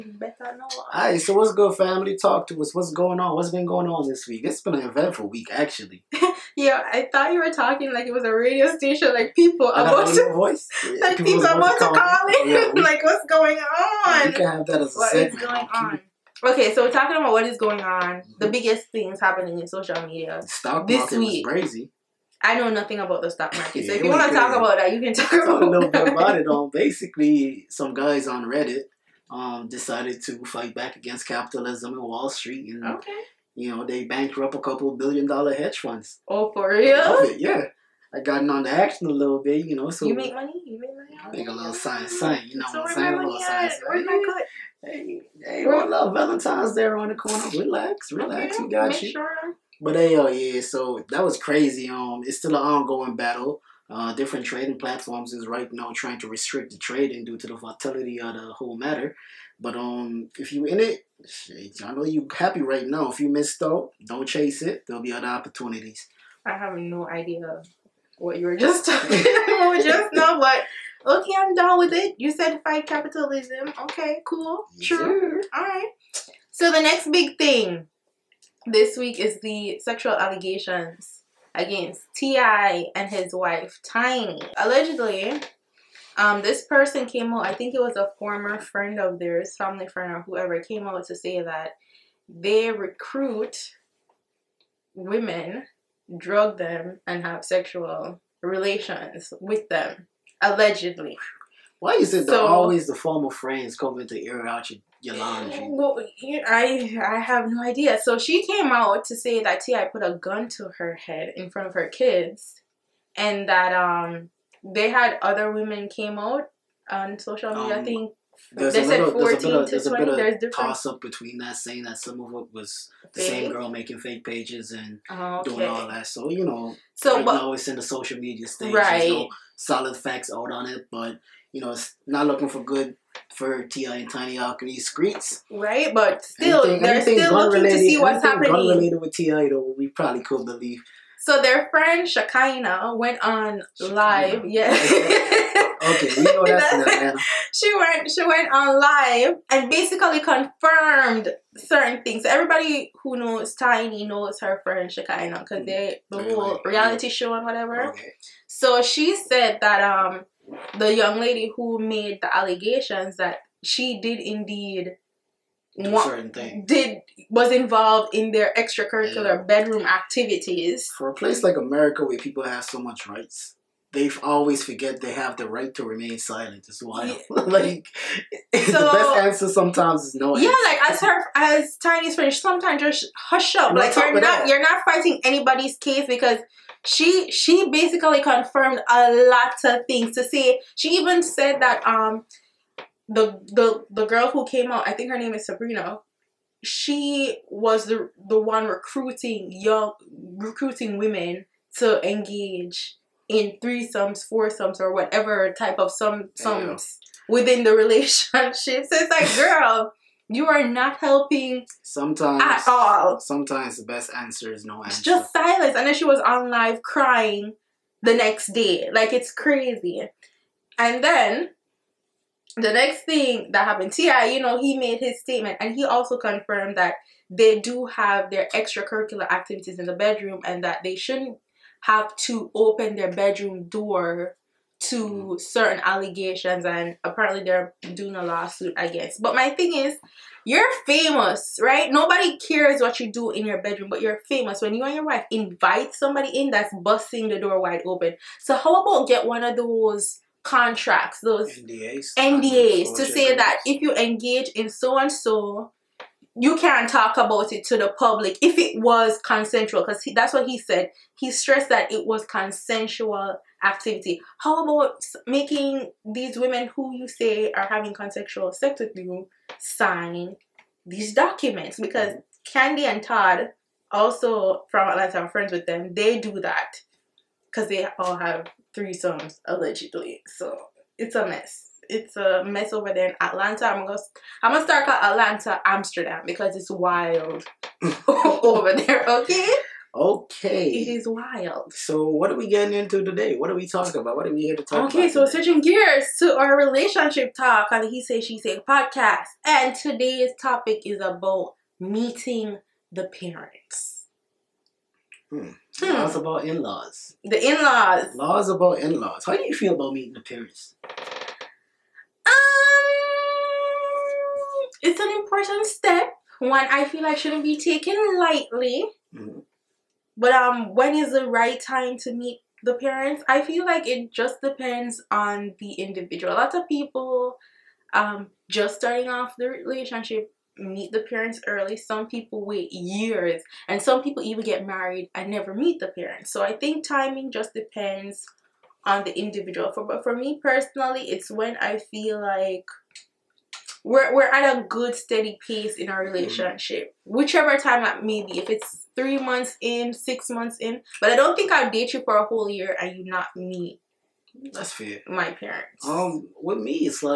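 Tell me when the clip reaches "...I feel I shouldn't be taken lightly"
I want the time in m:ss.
5:16.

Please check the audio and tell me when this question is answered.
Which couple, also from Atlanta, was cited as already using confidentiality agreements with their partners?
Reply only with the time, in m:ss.
4:32.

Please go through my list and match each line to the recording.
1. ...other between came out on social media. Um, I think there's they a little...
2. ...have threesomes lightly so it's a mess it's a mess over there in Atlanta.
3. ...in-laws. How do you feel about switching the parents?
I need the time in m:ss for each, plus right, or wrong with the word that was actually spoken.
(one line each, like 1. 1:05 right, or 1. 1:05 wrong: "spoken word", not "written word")
1. 1:55 wrong: "women", not "between"
2. 4:38 wrong: "allegedly", not "lightly"
3. 5:08 wrong: "meeting", not "switching".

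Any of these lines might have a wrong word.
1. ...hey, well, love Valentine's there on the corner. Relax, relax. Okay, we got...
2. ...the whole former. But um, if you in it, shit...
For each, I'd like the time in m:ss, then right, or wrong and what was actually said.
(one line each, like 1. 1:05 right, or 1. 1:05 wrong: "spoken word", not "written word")
1. 0:45 right
2. 0:58 wrong: "matter", not "former".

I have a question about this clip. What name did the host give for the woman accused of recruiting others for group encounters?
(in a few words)
Sabrina.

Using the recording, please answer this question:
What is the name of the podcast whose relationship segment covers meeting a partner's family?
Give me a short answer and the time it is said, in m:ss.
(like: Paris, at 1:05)
He Say She Say, at 4:57.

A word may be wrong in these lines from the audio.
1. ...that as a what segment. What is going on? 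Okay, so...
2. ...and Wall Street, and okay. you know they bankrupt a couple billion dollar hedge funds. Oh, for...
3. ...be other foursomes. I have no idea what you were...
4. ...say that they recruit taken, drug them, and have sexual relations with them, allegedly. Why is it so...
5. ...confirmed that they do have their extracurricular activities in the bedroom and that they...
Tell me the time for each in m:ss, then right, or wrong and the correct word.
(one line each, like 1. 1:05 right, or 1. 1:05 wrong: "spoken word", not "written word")
1. 0:14 right
2. 0:31 right
3. 1:05 wrong: "opportunities", not "foursomes"
4. 1:31 wrong: "women", not "taken"
5. 3:46 right.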